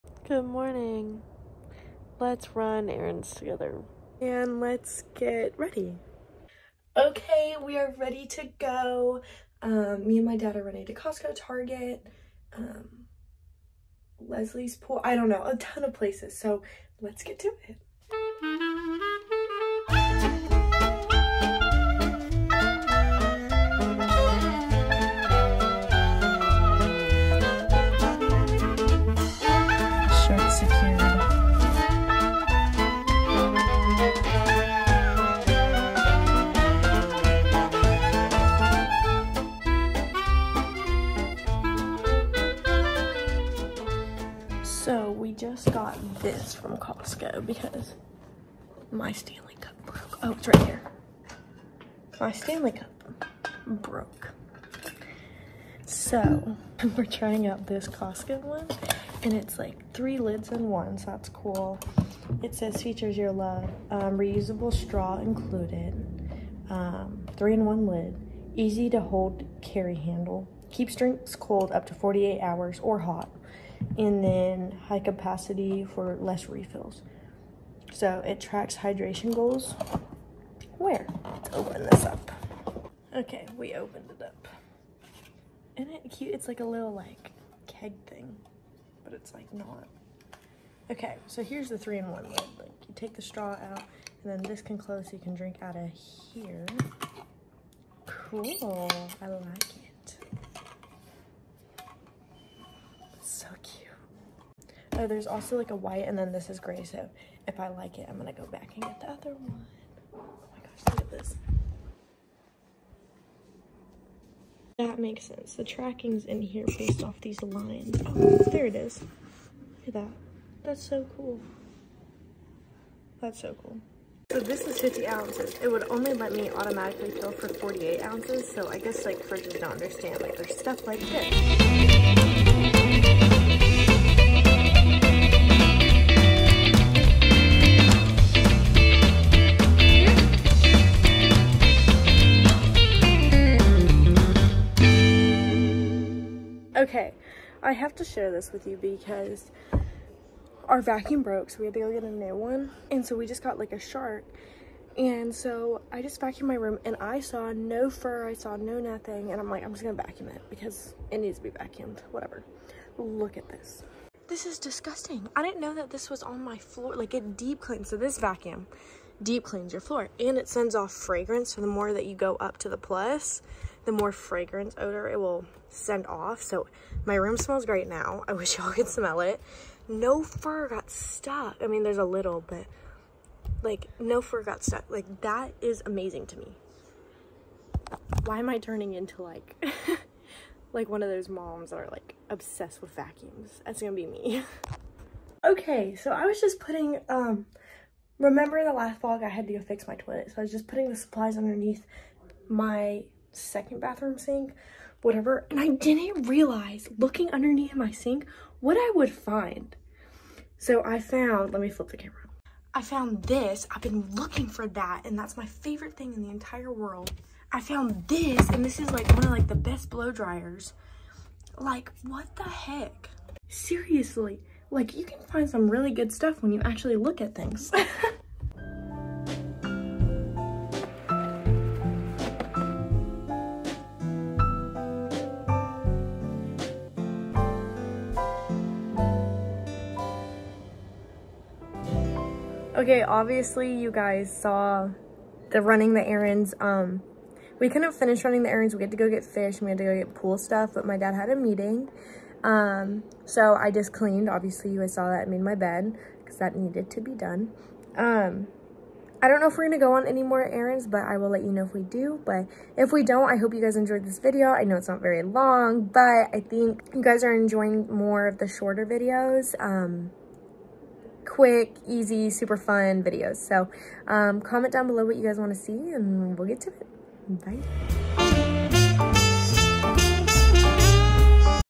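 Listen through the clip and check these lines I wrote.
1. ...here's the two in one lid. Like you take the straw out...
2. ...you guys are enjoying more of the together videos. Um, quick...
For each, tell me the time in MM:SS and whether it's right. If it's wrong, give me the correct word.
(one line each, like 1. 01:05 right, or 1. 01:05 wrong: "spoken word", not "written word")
1. 01:31 wrong: "three", not "two"
2. 04:26 wrong: "shorter", not "together".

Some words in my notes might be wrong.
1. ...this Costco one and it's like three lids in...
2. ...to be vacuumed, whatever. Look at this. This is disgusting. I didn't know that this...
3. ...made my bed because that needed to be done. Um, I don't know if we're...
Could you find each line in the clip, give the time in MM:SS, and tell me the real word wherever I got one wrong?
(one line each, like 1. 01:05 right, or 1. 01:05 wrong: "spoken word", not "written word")
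1. 00:57 right
2. 02:41 right
3. 04:15 right.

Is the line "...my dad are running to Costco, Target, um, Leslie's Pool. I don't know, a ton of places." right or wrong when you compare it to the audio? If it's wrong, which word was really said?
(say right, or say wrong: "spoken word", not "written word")
right.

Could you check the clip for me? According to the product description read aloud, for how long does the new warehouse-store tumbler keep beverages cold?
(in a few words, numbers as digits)
48 hours.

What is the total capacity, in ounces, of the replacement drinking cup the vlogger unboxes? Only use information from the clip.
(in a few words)
50 ounces.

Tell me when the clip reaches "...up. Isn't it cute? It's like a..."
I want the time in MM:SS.
01:24.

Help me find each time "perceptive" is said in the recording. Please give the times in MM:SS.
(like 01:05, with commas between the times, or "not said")
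not said.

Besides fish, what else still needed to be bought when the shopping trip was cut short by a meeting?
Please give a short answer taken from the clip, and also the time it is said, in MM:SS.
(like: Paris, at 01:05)
pool stuff, at 04:10.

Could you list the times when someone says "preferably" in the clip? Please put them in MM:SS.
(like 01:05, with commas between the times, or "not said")
not said.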